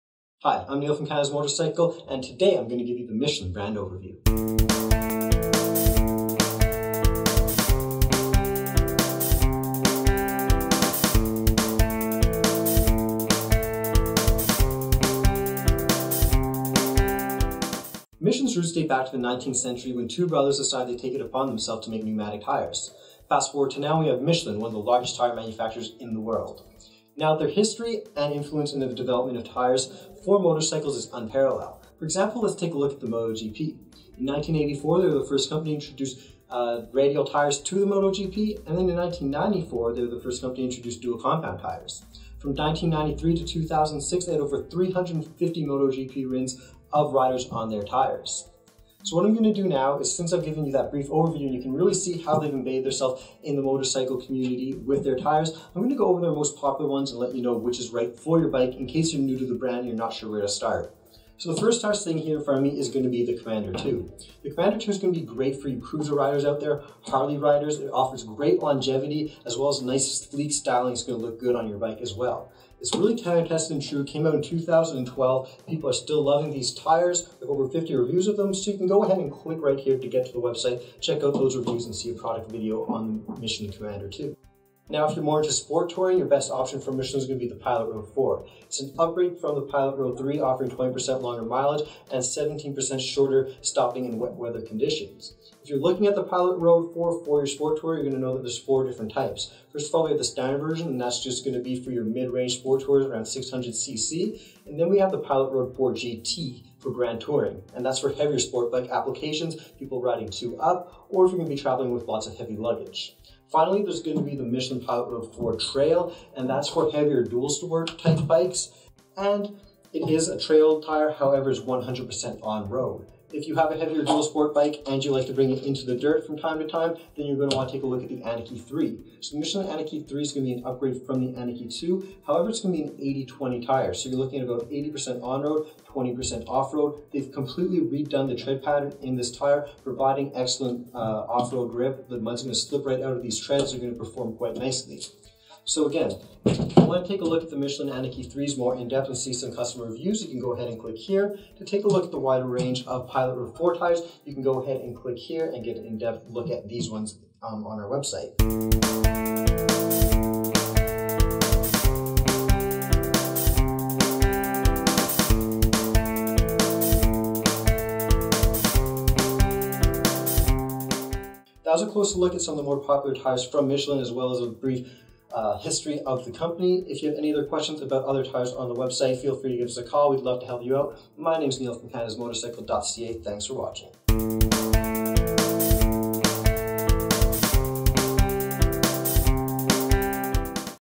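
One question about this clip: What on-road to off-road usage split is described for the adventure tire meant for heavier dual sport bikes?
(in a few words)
80-20.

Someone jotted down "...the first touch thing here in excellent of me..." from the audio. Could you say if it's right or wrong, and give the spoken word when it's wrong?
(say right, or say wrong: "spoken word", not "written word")
wrong: "front", not "excellent".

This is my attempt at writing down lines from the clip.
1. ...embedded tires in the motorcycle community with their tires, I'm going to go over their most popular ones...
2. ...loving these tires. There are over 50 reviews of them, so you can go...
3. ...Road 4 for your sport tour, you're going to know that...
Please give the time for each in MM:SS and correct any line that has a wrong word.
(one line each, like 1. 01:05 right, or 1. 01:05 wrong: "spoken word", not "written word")
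1. 00:52 wrong: "themselves", not "tires"
2. 01:16 right
3. 01:36 right.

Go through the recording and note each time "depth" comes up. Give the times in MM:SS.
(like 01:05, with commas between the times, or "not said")
02:28, 02:35.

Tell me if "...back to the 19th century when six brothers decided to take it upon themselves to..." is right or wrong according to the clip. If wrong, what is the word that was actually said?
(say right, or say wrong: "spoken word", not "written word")
wrong: "two", not "six".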